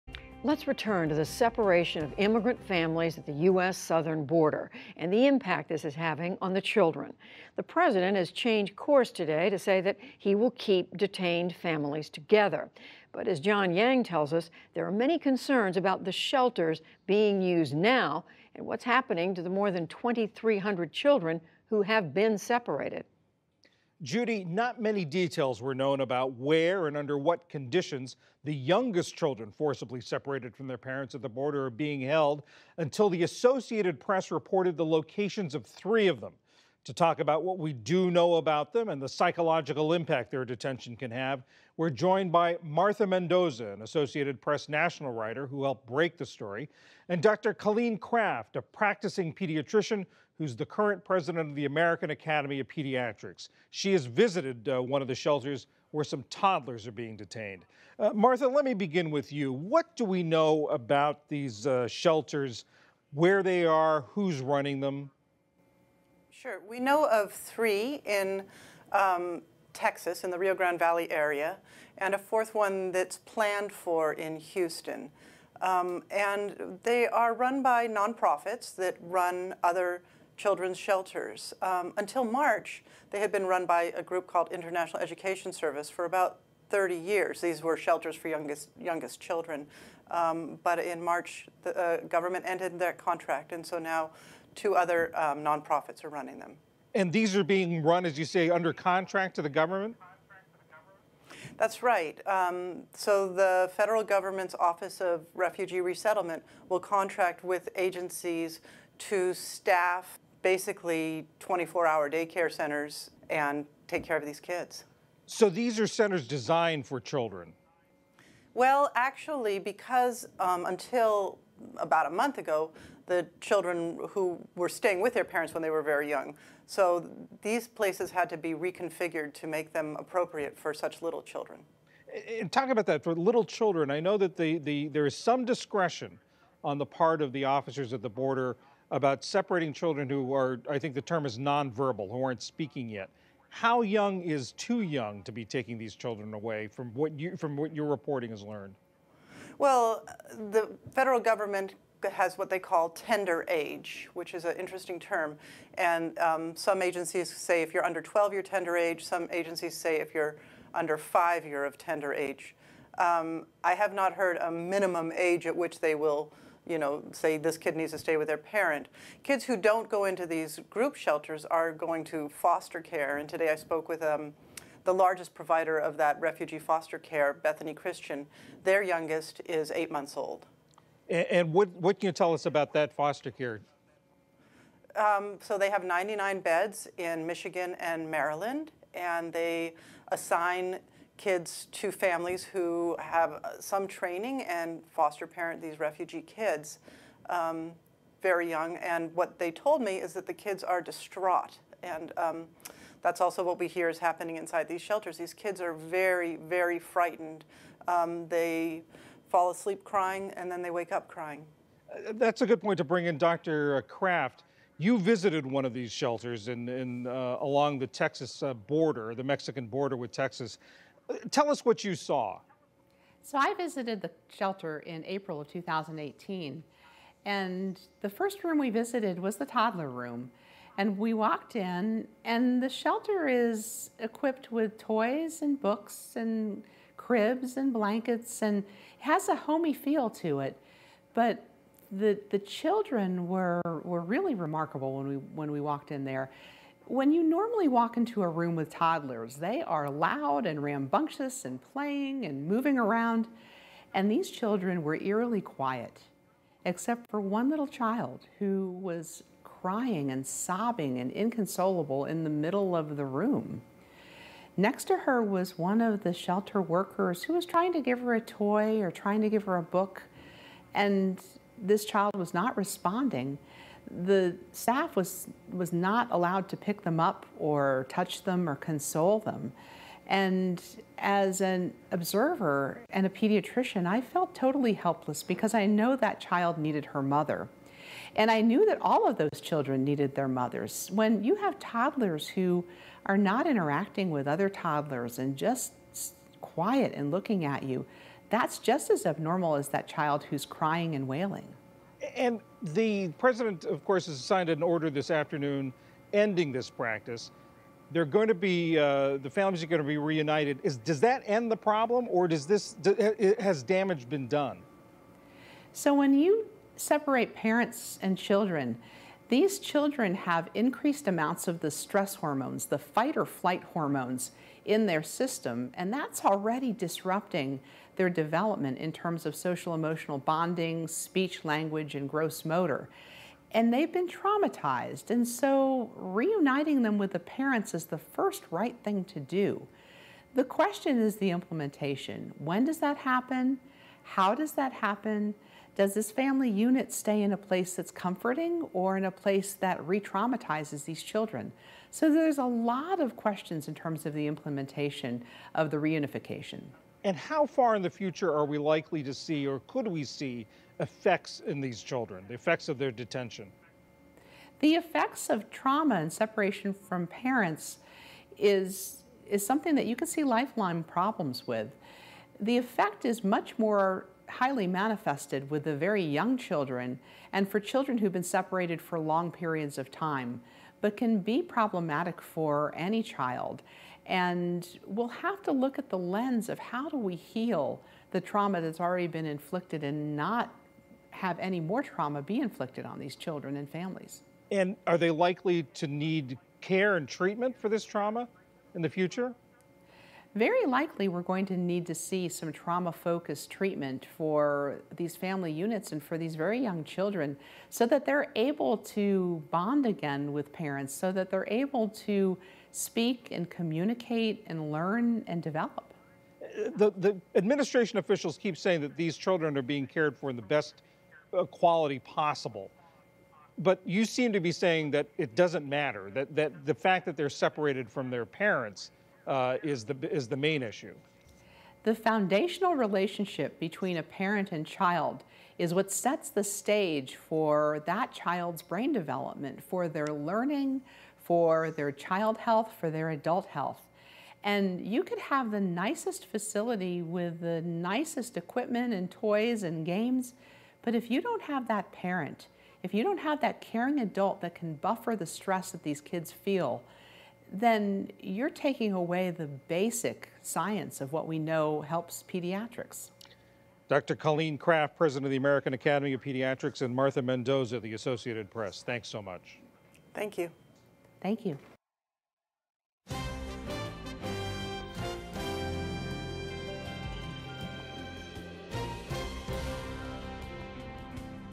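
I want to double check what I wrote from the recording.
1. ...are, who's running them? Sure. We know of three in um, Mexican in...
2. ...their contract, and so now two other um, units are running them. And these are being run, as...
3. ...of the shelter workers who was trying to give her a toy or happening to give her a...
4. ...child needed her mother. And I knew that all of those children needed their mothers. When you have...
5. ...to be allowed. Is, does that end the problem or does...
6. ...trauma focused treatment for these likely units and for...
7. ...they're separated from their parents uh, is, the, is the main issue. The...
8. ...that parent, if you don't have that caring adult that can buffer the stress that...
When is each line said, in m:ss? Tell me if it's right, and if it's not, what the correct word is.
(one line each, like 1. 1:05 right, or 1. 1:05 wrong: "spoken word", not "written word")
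1. 1:03 wrong: "Texas", not "Mexican"
2. 1:32 wrong: "nonprofits", not "units"
3. 4:25 wrong: "trying", not "happening"
4. 4:46 right
5. 5:09 wrong: "reunited", not "allowed"
6. 6:42 wrong: "family", not "likely"
7. 7:07 right
8. 7:31 right.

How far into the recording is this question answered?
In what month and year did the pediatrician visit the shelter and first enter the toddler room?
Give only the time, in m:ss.
3:45.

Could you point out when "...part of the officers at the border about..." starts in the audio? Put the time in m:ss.
2:16.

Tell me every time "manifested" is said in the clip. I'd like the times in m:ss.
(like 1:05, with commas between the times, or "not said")
6:14.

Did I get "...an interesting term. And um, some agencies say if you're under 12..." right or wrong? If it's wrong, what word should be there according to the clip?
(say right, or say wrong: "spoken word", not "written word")
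right.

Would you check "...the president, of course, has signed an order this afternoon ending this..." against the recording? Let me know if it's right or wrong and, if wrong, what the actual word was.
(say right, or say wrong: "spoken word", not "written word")
right.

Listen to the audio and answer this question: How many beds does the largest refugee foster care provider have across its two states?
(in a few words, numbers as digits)
99.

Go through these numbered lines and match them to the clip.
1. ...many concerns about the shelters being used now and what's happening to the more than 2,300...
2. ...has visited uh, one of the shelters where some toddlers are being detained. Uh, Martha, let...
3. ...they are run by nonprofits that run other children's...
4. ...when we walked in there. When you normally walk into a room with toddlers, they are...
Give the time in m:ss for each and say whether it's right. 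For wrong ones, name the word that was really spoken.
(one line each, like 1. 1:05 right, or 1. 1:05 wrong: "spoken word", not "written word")
1. 0:14 right
2. 0:53 right
3. 1:16 right
4. 4:05 right.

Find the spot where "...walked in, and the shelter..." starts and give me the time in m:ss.
3:51.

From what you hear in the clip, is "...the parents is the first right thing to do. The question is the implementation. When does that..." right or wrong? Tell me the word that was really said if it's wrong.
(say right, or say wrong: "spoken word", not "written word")
right.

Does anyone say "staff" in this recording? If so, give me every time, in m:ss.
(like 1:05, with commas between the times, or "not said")
1:49, 4:34.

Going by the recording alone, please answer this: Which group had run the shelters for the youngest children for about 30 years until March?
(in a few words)
International Education Service.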